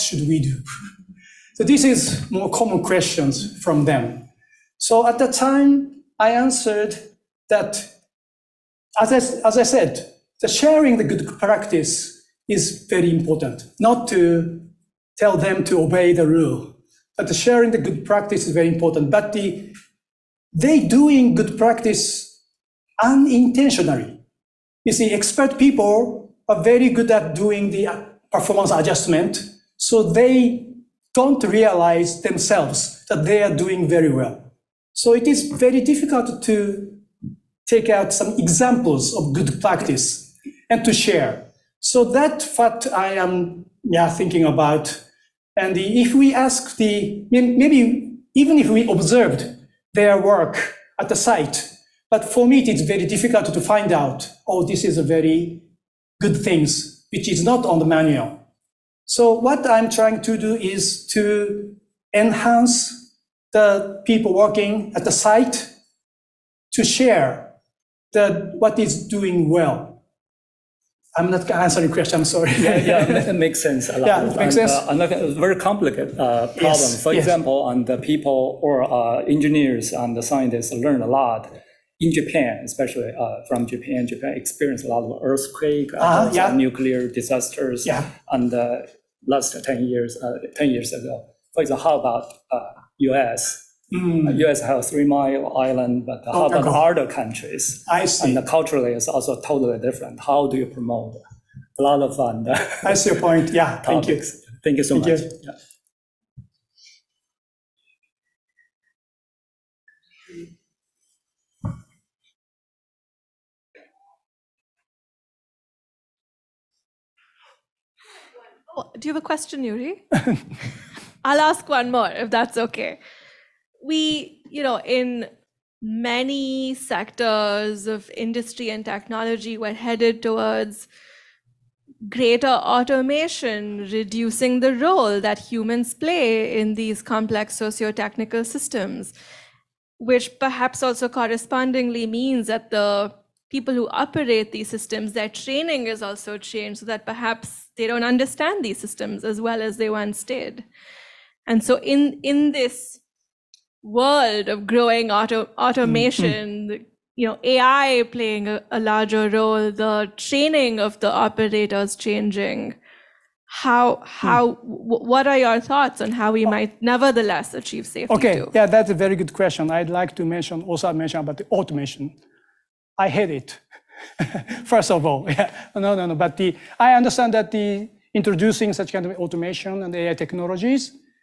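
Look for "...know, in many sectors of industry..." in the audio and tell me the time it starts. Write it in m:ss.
2:04.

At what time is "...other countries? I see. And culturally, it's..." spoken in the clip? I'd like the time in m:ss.
1:36.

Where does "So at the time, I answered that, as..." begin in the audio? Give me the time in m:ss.
0:04.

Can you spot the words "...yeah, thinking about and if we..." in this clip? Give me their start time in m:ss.
0:43.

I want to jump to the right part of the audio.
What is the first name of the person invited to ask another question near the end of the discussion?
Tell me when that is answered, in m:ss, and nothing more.
1:59.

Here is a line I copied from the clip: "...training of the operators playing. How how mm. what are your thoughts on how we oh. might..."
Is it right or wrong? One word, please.
wrong.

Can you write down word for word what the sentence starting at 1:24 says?
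Japan experienced a lot of earthquake, uh uh-huh, yeah.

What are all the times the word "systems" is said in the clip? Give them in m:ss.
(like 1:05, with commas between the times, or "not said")
2:18, 2:24, 2:28.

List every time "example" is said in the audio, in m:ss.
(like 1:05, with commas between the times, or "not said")
0:38, 1:17, 1:31.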